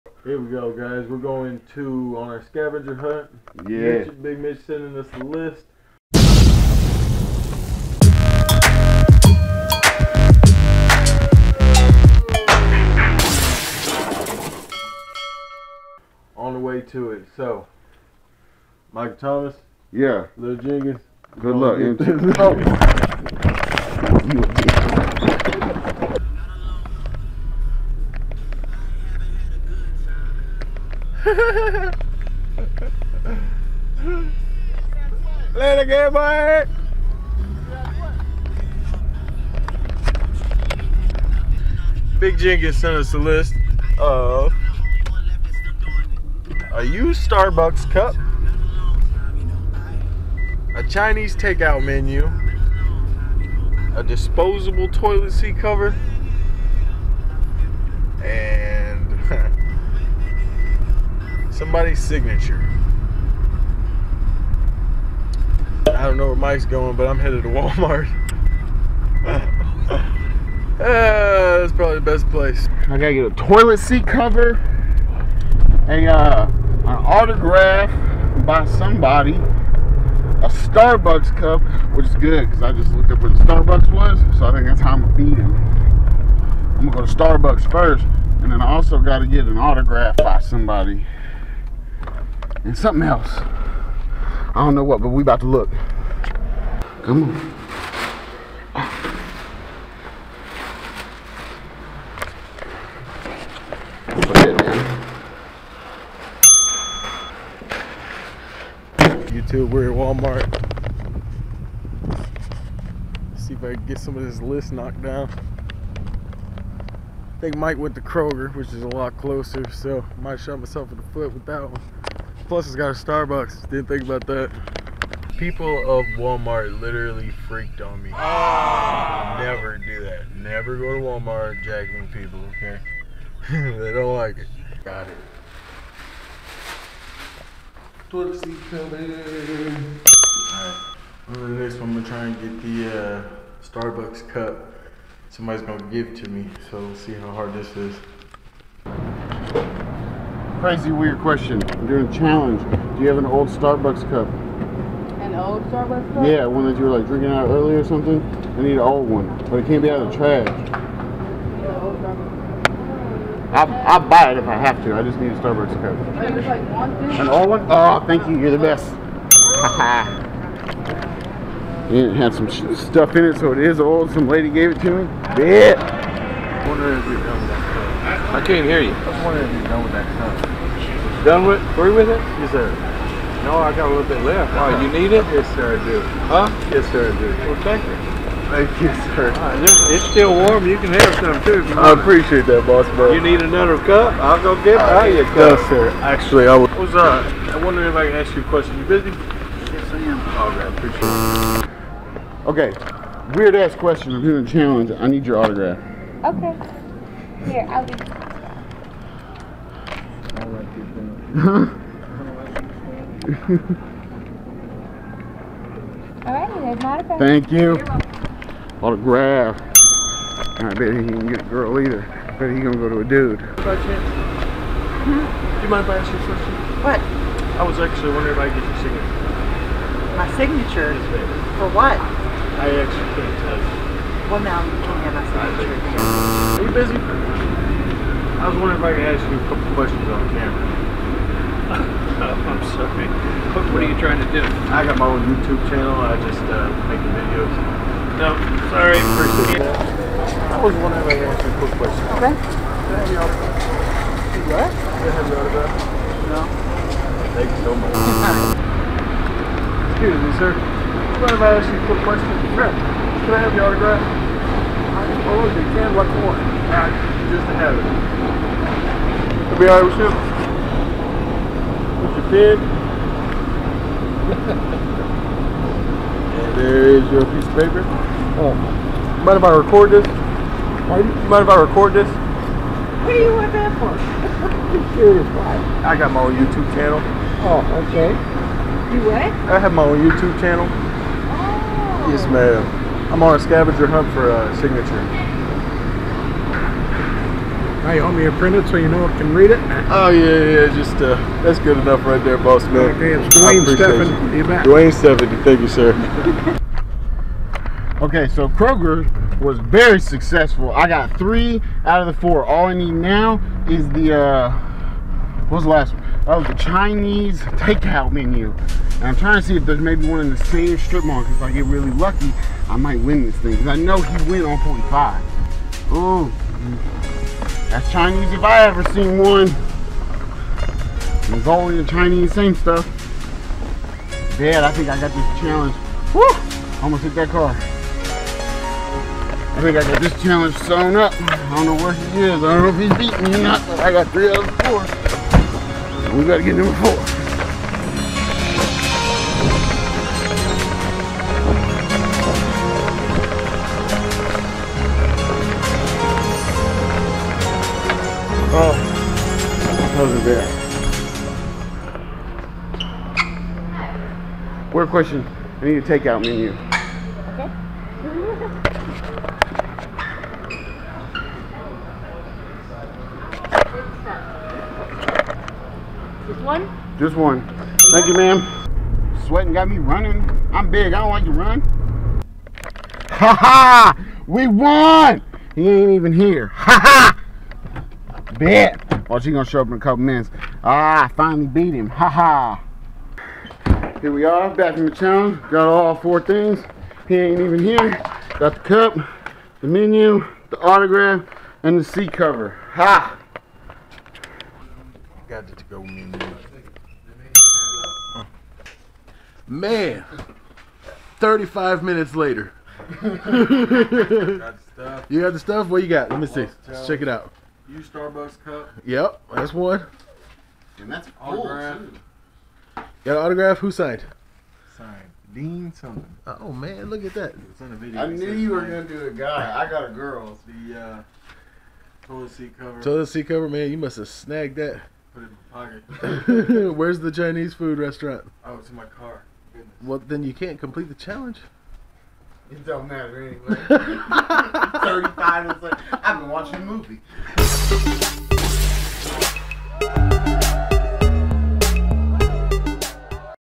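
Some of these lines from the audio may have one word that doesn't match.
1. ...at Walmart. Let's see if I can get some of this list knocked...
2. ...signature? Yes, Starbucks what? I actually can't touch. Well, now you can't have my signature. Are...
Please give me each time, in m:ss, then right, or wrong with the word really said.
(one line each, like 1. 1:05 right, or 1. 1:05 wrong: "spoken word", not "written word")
1. 1:49 right
2. 3:50 wrong: "For", not "Starbucks".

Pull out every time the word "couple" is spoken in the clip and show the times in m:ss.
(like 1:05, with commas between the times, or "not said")
3:59, 6:29.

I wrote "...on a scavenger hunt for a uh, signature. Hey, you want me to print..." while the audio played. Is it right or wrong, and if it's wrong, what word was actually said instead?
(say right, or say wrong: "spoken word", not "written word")
right.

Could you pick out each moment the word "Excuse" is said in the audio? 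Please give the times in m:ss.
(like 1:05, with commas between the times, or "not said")
4:17.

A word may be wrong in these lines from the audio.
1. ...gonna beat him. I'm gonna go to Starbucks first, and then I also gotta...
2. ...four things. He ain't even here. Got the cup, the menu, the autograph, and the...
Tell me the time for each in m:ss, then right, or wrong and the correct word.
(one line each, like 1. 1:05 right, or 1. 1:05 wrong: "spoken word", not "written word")
1. 1:25 right
2. 6:35 right.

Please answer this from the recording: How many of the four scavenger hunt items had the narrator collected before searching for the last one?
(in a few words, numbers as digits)
3.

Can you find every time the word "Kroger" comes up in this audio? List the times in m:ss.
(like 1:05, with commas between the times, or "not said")
1:58, 5:08.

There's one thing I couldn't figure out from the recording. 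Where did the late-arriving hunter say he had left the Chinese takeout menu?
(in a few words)
in my car.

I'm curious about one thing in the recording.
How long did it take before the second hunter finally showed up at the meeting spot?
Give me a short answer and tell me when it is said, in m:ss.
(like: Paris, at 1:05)
35 minutes, at 6:51.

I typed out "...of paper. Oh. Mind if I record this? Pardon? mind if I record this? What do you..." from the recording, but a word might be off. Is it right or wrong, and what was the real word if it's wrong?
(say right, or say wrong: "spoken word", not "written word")
right.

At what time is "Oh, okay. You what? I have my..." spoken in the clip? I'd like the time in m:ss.
4:47.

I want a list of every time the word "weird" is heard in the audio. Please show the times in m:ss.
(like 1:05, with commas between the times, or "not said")
2:30, 3:23.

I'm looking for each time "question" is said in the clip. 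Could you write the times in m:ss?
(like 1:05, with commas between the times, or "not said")
2:31, 3:18, 3:23, 3:46, 3:59, 4:11, 4:22, 6:05.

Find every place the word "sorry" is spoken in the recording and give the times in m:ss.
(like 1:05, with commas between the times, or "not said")
4:02, 4:08.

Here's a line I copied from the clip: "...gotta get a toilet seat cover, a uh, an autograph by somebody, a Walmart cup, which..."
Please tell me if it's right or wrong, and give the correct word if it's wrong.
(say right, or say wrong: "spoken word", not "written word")
wrong: "Starbucks", not "Walmart".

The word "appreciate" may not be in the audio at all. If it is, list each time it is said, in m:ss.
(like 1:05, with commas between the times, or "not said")
3:11, 3:22, 4:08.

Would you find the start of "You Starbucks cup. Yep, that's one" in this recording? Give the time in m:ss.
6:57.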